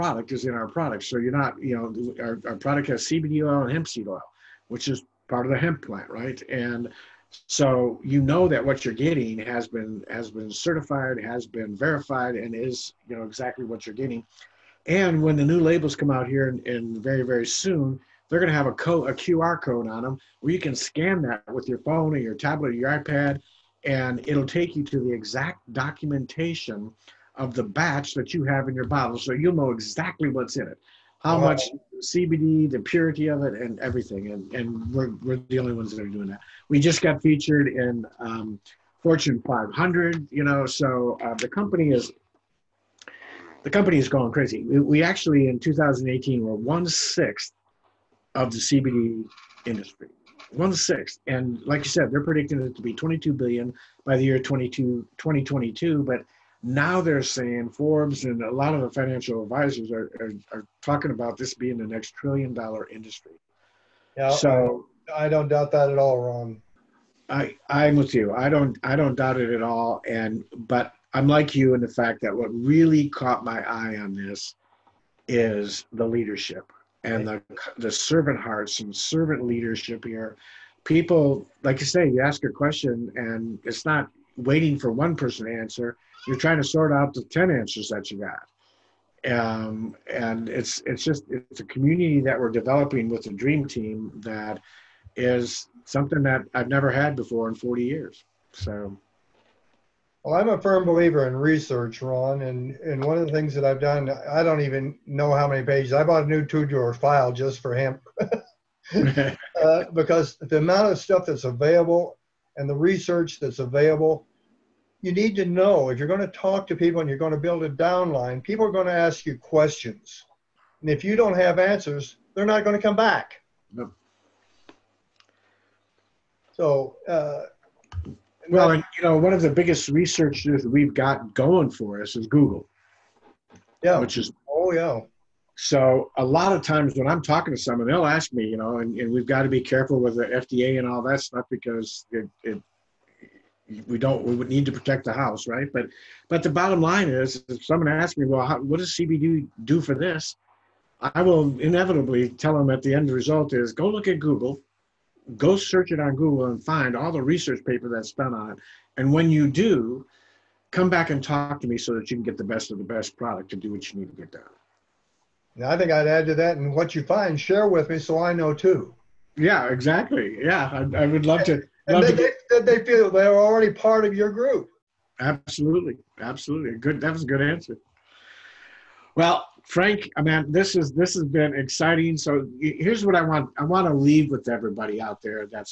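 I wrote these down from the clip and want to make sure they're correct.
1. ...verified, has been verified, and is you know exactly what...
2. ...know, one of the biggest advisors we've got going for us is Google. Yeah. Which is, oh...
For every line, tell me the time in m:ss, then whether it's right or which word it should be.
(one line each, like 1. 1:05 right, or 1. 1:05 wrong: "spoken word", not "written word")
1. 0:10 wrong: "certified", not "verified"
2. 2:09 wrong: "researchers", not "advisors".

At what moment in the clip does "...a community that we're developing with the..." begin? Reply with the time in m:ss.
1:31.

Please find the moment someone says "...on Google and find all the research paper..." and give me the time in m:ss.
2:35.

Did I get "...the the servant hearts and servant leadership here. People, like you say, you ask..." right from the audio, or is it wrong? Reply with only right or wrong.
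right.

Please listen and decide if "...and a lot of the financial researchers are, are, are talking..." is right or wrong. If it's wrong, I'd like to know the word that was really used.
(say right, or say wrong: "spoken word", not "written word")
wrong: "advisors", not "researchers".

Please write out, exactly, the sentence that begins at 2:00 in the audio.
And if you don't have answers, they're not going to come back.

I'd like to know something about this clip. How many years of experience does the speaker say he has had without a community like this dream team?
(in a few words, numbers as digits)
40.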